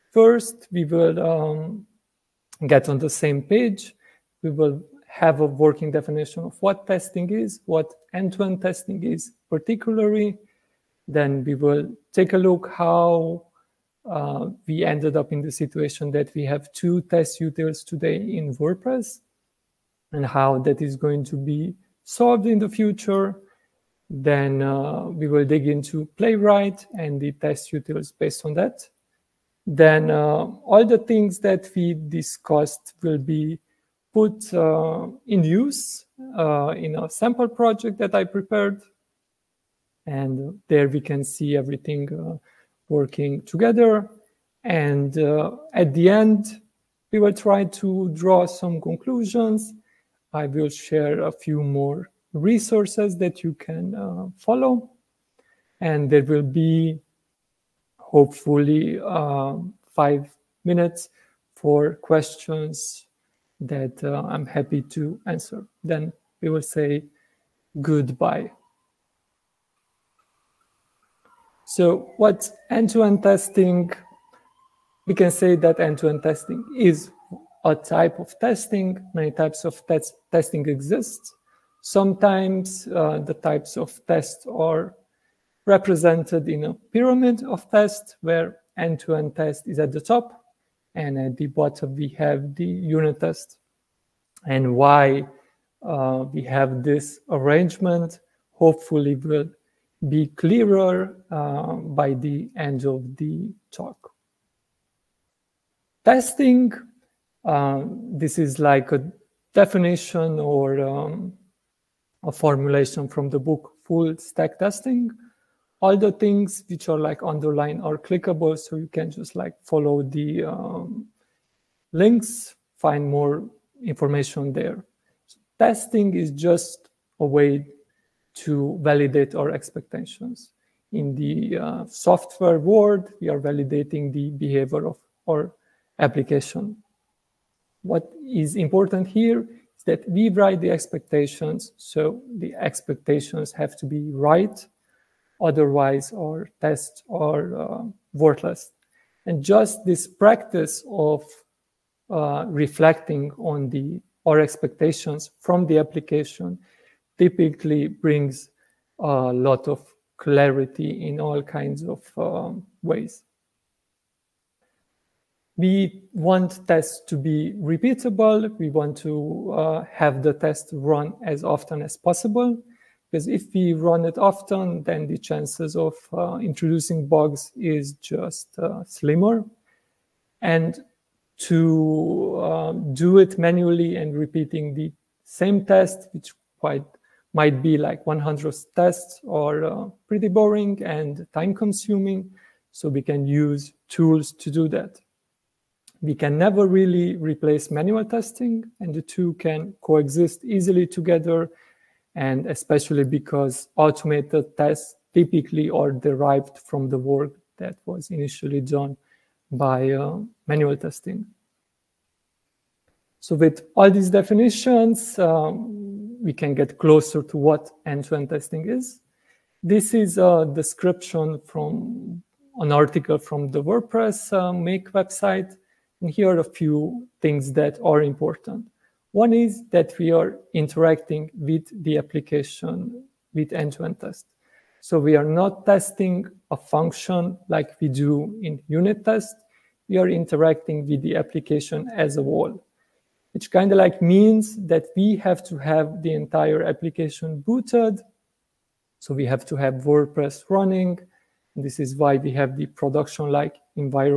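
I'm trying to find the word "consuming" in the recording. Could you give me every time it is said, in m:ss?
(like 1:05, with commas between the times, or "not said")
3:11.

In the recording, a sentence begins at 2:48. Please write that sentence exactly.
We want to uh, have the test run as often as possible.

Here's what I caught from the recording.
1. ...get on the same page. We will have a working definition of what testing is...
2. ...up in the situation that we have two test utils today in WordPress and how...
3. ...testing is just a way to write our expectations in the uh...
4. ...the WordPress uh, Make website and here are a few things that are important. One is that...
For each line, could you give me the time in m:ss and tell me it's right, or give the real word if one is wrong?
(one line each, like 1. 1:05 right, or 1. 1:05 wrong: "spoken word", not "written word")
1. 0:02 right
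2. 0:15 right
3. 2:05 wrong: "validate", not "write"
4. 3:43 right.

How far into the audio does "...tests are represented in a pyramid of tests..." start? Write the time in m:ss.
1:24.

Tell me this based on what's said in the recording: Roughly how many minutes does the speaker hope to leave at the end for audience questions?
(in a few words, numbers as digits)
5.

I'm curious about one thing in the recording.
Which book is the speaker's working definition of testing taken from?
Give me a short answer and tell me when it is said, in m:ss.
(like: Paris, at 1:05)
Full Stack Testing, at 1:53.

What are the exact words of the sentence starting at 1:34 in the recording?
And why uh, we have this arrangement hopefully will be clearer uh, by the end of the talk.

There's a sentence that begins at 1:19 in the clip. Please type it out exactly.
Many types of tes testing exist.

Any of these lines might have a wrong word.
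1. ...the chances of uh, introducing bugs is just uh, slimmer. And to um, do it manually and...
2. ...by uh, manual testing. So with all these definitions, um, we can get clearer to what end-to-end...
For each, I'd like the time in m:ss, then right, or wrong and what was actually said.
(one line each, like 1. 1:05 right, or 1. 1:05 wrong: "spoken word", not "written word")
1. 2:55 right
2. 3:29 wrong: "closer", not "clearer".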